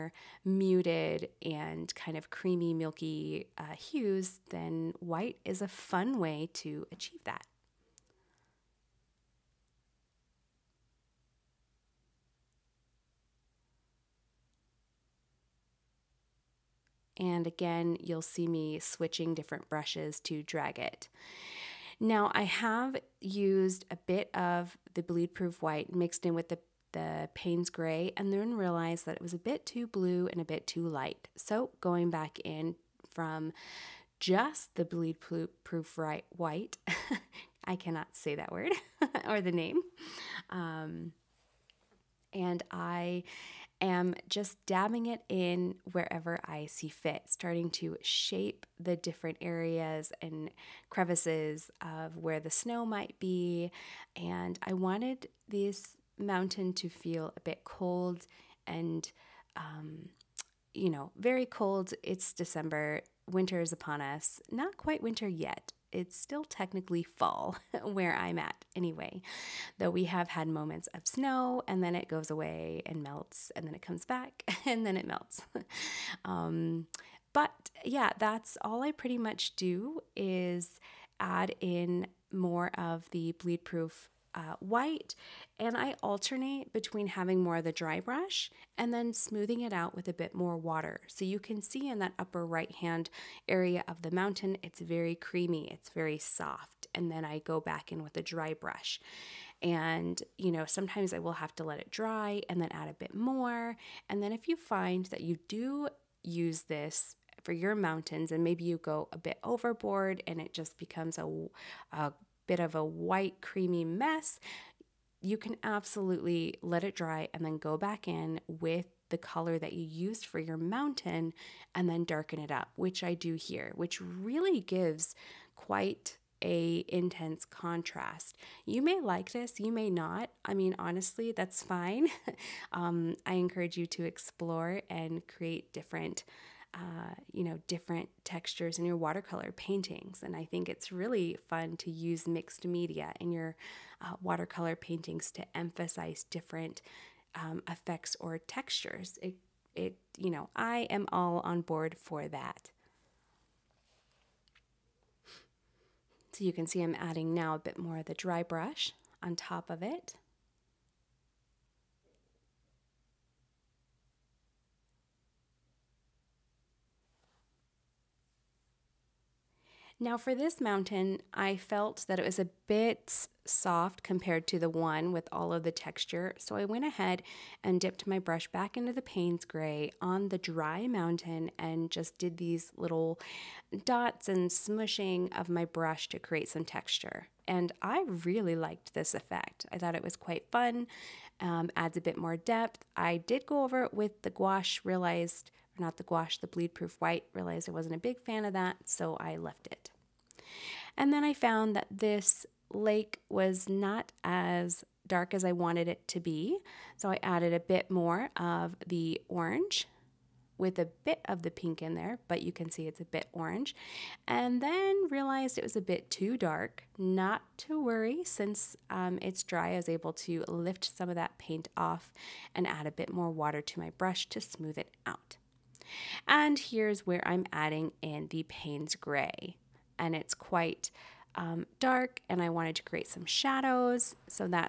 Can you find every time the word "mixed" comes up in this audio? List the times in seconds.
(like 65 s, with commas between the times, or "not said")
25 s, 142 s.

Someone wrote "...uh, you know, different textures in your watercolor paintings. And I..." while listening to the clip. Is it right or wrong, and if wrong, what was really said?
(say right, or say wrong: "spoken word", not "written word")
right.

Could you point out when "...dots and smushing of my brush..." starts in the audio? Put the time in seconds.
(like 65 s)
183 s.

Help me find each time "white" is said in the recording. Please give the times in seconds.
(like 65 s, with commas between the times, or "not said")
4 s, 25 s, 36 s, 84 s, 112 s, 197 s.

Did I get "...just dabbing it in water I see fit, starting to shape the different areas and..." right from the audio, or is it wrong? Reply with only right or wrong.
wrong.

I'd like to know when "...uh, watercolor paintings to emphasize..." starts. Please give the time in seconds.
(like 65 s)
144 s.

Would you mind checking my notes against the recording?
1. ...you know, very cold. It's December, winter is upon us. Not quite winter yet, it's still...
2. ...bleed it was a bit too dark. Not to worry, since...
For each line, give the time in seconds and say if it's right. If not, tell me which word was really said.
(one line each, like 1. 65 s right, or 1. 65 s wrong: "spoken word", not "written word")
1. 60 s right
2. 215 s wrong: "realized", not "bleed".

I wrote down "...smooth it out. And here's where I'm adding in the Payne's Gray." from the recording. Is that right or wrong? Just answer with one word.
right.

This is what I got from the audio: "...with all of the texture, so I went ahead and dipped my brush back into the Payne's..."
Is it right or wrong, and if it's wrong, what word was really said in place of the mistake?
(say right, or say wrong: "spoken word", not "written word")
right.